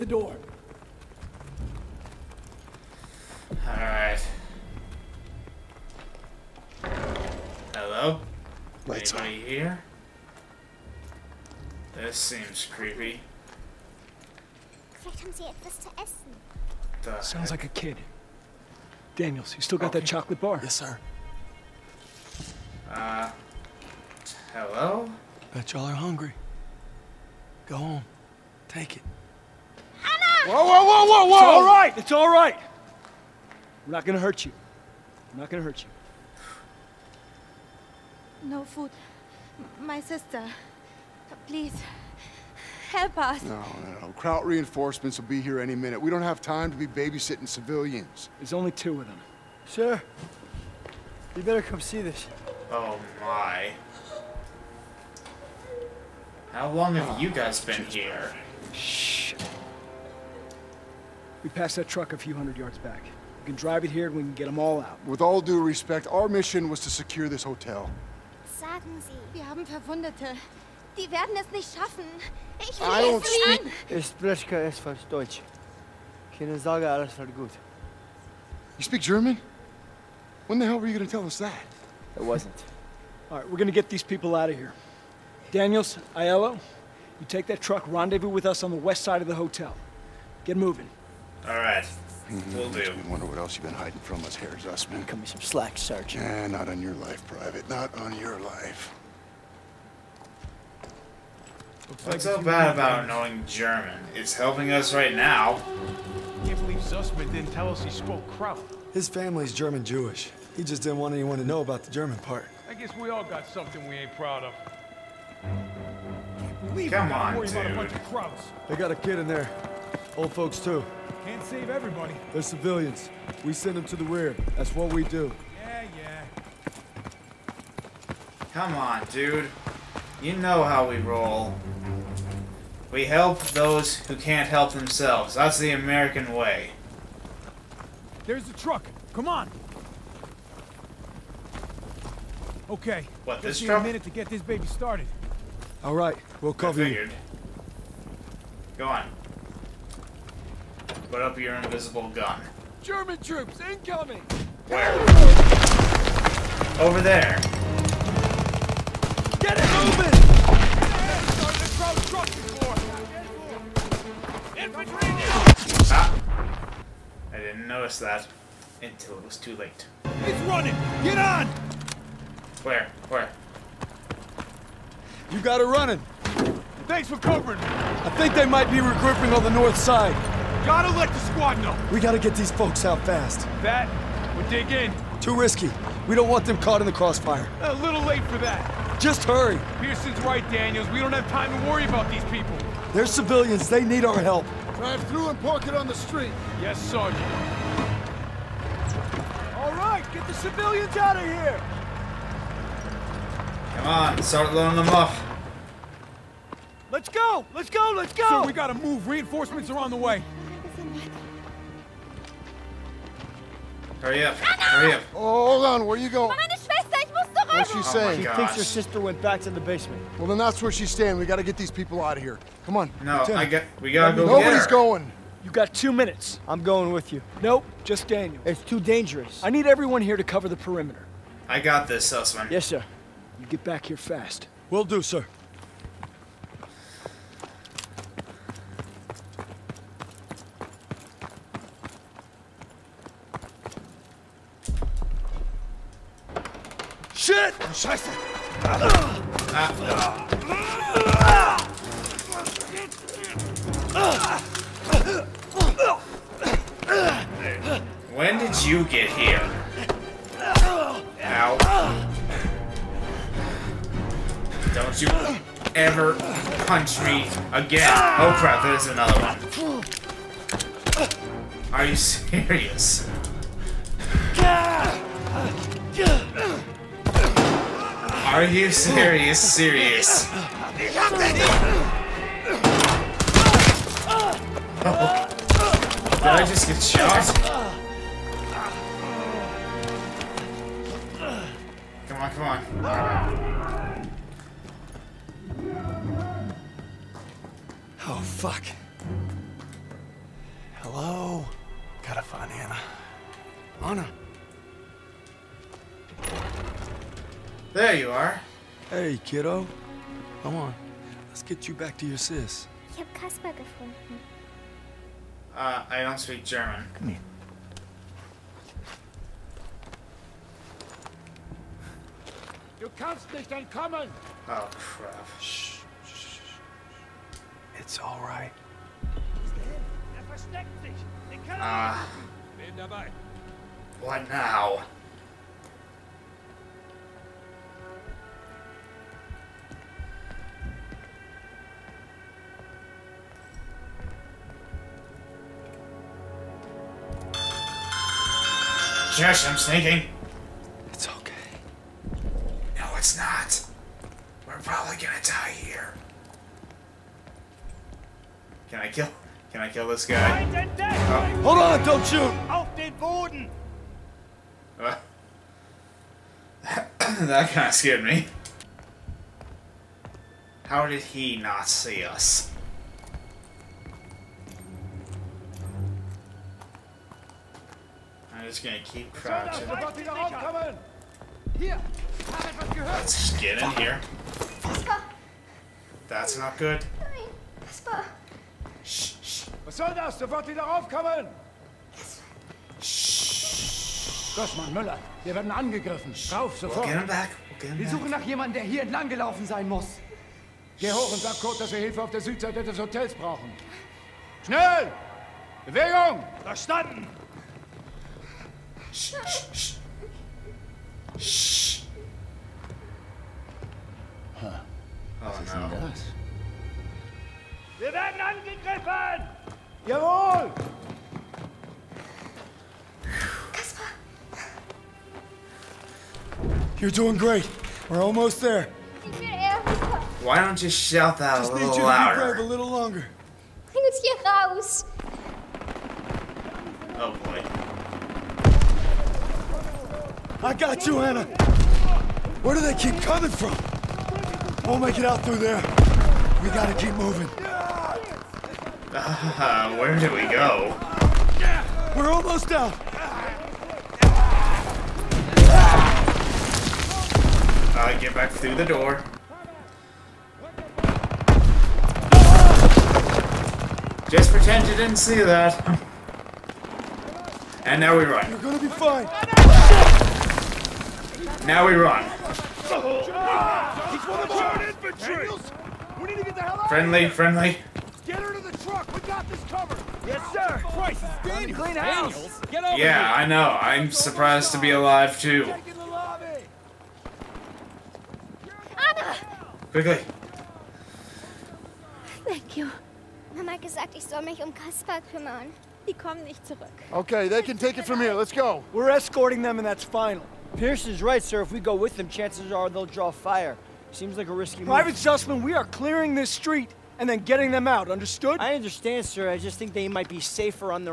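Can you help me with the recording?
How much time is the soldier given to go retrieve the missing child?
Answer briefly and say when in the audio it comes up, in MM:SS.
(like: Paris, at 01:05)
2 minutes, at 03:45.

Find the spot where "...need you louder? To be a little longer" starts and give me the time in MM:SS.
07:11.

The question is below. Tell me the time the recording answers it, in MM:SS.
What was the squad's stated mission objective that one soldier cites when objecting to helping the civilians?
01:06.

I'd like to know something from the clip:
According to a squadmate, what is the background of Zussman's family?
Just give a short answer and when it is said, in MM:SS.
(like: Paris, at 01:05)
German-Jewish, at 01:49.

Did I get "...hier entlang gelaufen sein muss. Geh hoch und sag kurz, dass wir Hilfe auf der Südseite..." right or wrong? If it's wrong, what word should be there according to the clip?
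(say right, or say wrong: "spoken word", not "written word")
right.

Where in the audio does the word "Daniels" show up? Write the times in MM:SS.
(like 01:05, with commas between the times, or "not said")
00:19, 01:25, 03:10, 03:48, 08:01.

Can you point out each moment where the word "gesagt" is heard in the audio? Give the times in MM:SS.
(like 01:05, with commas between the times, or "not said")
08:13.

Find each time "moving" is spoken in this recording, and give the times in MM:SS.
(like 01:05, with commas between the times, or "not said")
01:30, 02:39, 07:26.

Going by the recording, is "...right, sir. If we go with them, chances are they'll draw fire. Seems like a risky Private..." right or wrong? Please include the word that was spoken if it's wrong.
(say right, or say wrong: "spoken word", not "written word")
right.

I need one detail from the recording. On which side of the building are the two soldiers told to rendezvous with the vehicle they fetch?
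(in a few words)
west side.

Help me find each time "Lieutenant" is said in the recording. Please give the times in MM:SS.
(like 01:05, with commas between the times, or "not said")
03:43.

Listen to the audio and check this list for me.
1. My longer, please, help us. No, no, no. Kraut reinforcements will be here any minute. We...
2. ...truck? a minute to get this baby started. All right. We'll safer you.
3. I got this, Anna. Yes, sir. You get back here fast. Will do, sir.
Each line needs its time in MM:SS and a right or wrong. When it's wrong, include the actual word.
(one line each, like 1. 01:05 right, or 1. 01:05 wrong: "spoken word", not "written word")
1. 00:39 wrong: "sister", not "longer"
2. 02:23 wrong: "cover", not "safer"
3. 03:51 wrong: "Zussman", not "Anna".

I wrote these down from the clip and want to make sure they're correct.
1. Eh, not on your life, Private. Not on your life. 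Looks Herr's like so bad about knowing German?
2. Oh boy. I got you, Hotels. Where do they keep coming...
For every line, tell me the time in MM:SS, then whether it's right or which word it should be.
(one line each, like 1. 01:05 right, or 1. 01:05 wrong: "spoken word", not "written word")
1. 01:36 wrong: "What", not "Herr"
2. 07:16 wrong: "Anna", not "Hotels".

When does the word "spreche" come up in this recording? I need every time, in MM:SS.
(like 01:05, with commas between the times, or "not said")
01:14.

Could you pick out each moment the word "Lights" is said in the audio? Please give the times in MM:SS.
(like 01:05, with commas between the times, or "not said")
00:08.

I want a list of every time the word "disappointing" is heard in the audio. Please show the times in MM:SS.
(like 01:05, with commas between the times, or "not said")
not said.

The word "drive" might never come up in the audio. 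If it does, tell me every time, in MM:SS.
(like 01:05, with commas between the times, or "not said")
01:03, 03:14.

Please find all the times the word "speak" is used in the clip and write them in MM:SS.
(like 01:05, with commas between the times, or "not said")
01:18, 05:16.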